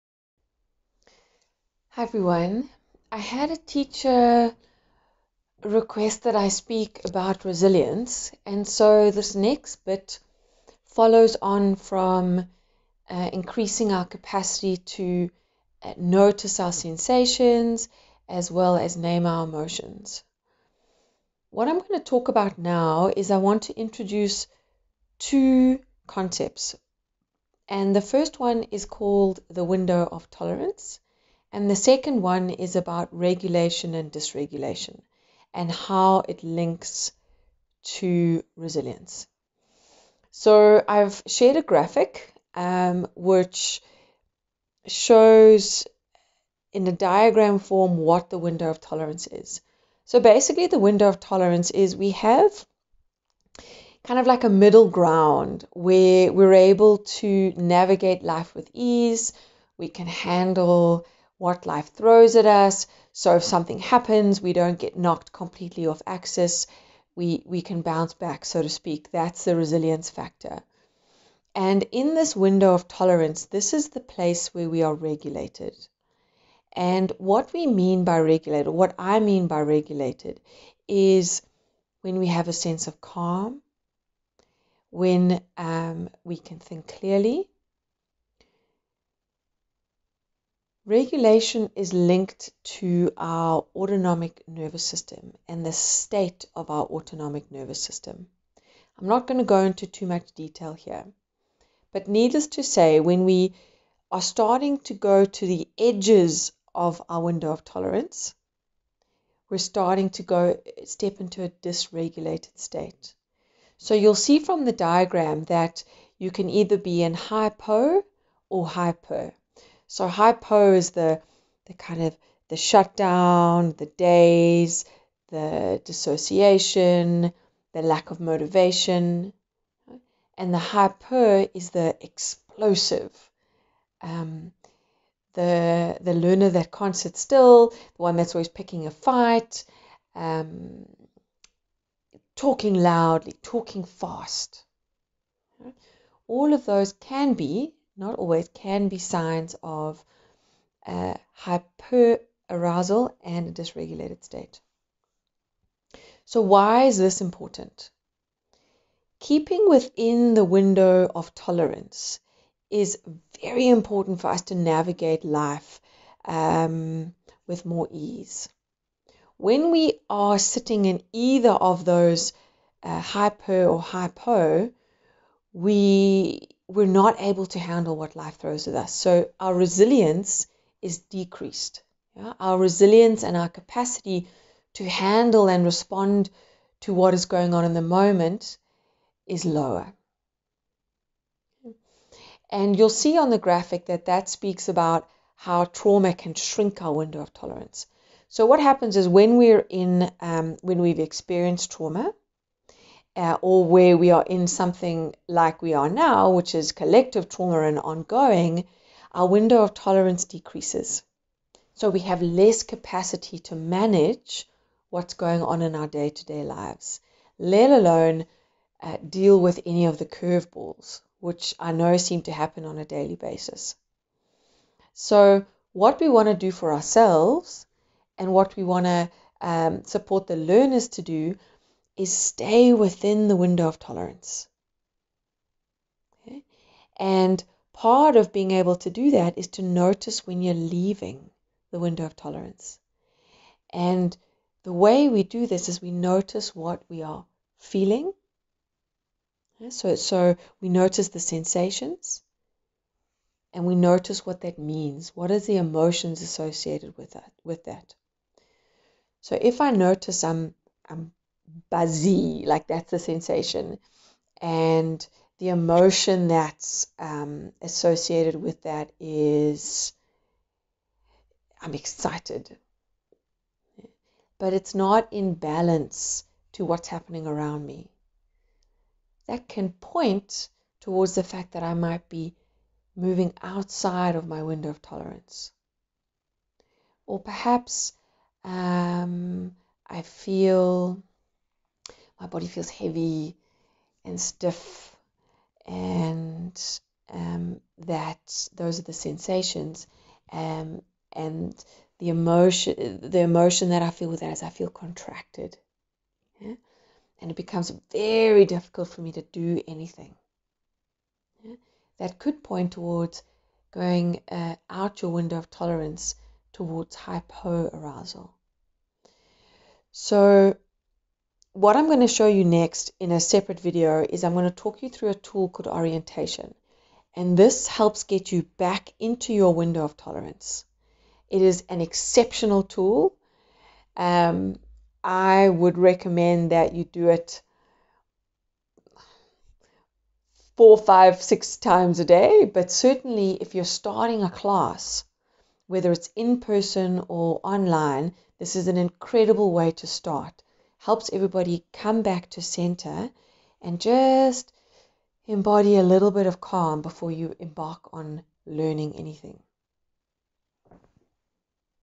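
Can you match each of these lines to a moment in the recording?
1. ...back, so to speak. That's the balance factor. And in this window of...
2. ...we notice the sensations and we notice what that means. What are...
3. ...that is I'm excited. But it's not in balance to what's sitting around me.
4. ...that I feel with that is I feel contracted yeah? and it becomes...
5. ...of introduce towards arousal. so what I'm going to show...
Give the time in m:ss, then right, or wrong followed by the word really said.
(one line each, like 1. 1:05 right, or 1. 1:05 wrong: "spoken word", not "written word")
1. 1:08 wrong: "resilience", not "balance"
2. 4:10 right
3. 4:28 wrong: "happening", not "sitting"
4. 5:03 right
5. 5:15 wrong: "tolerance", not "introduce".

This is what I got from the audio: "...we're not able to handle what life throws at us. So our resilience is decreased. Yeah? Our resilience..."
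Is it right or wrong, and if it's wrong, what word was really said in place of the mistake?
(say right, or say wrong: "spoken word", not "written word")
right.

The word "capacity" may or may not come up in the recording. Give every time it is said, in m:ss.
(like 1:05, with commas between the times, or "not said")
0:14, 3:03, 3:32.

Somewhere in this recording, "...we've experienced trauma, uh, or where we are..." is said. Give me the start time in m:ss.
3:20.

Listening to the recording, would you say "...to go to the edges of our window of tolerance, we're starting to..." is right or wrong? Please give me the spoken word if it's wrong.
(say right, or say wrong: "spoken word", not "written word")
right.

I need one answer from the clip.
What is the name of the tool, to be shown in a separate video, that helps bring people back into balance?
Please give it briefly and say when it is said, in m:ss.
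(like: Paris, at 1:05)
orientation, at 5:25.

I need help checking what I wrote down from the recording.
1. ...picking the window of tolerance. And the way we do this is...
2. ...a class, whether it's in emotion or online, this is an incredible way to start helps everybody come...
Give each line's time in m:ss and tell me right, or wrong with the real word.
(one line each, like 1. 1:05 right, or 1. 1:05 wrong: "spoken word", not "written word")
1. 4:00 wrong: "leaving", not "picking"
2. 5:44 wrong: "person", not "emotion".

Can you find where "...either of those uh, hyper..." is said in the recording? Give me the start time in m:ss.
2:51.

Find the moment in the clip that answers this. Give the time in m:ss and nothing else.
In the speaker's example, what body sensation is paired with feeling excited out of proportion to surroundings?
4:21.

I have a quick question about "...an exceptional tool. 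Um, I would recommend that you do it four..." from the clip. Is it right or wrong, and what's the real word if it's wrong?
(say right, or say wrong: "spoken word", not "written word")
right.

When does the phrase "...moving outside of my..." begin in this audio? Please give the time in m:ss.
4:42.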